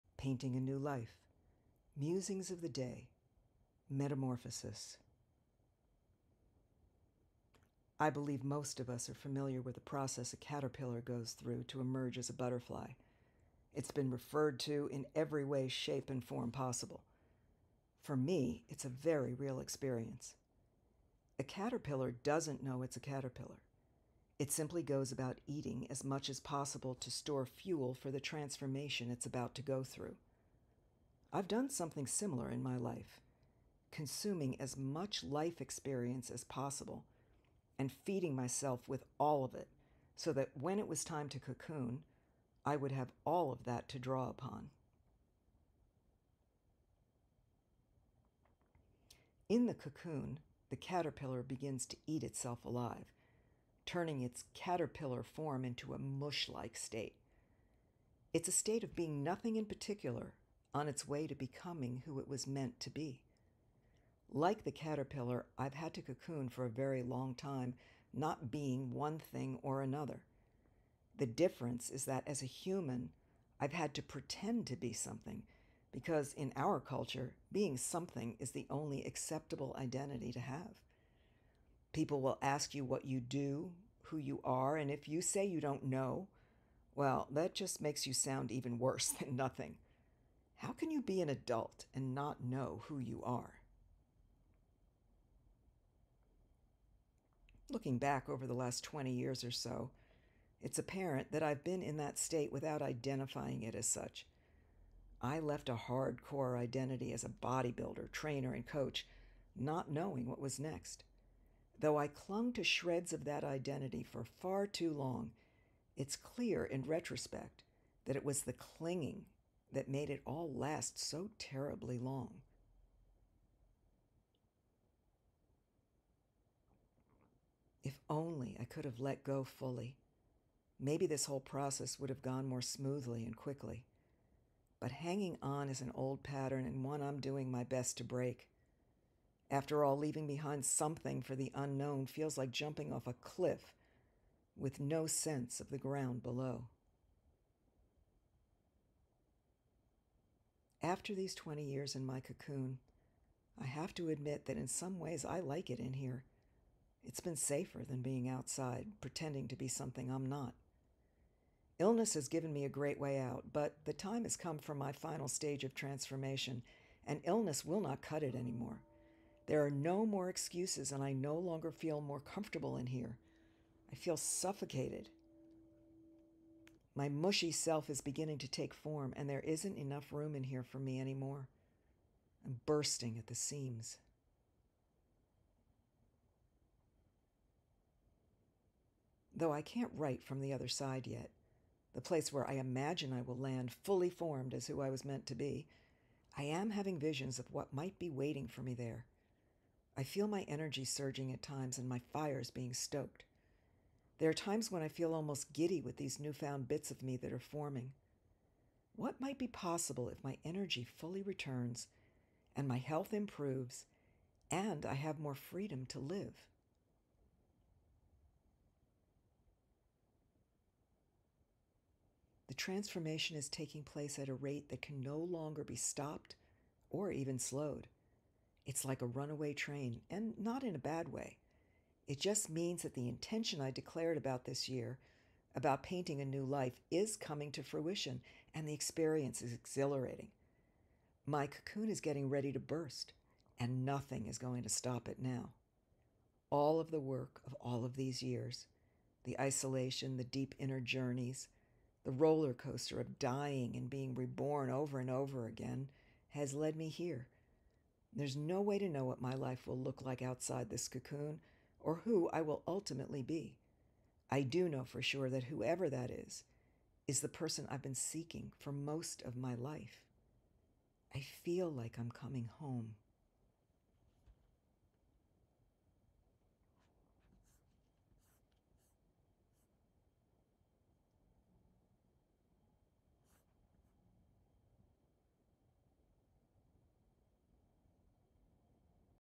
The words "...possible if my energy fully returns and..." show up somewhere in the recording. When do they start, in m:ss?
3:29.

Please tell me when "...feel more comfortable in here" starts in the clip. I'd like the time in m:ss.
2:51.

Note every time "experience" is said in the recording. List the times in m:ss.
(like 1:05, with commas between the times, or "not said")
0:19, 0:35, 3:58.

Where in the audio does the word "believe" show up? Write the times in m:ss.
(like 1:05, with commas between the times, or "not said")
0:08.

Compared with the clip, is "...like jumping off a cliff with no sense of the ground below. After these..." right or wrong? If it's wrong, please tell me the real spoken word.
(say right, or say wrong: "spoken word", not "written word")
right.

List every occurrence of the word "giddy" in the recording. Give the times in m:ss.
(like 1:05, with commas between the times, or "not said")
3:25.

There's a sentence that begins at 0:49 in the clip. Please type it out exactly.
In the cocoon, the caterpillar begins to eat itself alive turning its caterpillar form into a mush like state.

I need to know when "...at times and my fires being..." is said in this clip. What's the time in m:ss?
3:21.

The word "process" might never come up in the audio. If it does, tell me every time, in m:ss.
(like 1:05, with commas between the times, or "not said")
0:09, 2:11.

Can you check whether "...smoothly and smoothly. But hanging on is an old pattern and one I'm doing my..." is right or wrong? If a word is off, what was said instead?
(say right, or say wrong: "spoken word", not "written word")
wrong: "quickly", not "smoothly".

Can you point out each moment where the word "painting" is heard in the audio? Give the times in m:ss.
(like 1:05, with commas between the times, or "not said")
0:00, 3:55.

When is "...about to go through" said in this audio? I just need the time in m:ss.
0:29.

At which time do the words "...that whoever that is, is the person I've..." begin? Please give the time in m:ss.
4:25.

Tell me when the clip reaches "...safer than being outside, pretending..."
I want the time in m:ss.
2:37.